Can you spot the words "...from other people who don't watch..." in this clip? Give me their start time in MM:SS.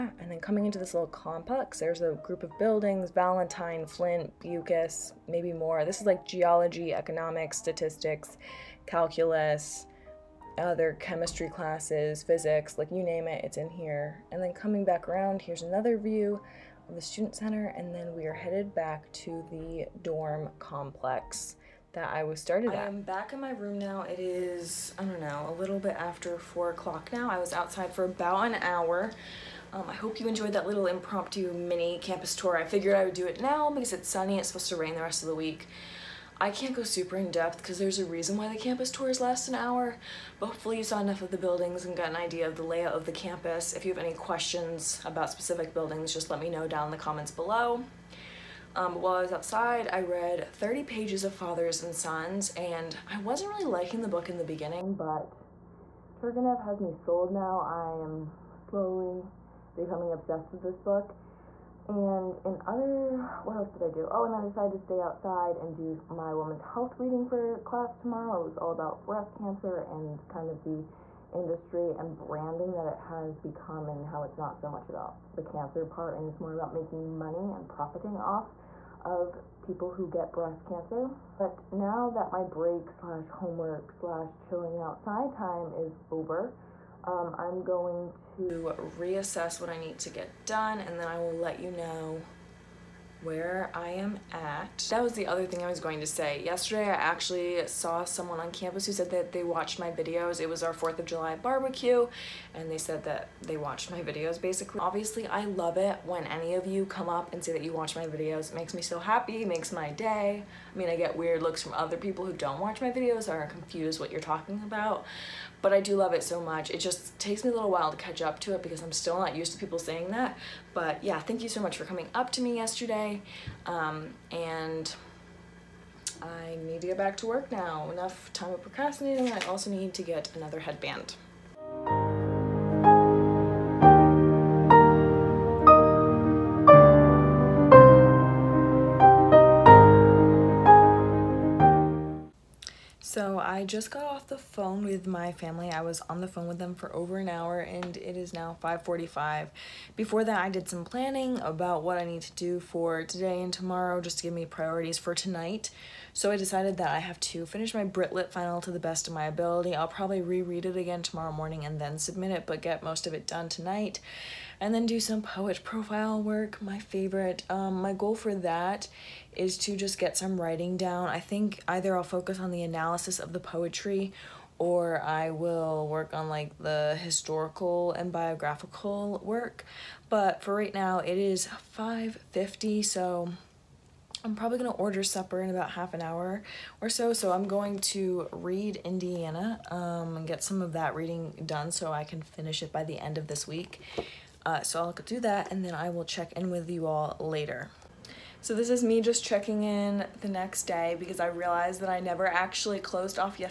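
01:51.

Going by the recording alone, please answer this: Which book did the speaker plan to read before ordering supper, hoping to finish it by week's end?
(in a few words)
Indiana.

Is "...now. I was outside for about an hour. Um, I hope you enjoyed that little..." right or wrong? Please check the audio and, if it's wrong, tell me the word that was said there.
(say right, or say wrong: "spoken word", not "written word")
right.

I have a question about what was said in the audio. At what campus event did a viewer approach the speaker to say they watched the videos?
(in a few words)
4th of July barbecue.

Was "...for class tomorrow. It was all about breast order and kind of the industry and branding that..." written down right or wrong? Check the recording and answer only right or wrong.
wrong.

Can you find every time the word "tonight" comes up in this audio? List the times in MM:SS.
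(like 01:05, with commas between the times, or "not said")
02:35, 02:43.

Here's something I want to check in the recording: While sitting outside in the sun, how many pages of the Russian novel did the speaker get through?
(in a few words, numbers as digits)
30.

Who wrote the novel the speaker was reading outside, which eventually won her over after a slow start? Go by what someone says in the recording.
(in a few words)
Turgenev.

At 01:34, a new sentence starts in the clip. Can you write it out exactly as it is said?
That was the other thing I was going to say.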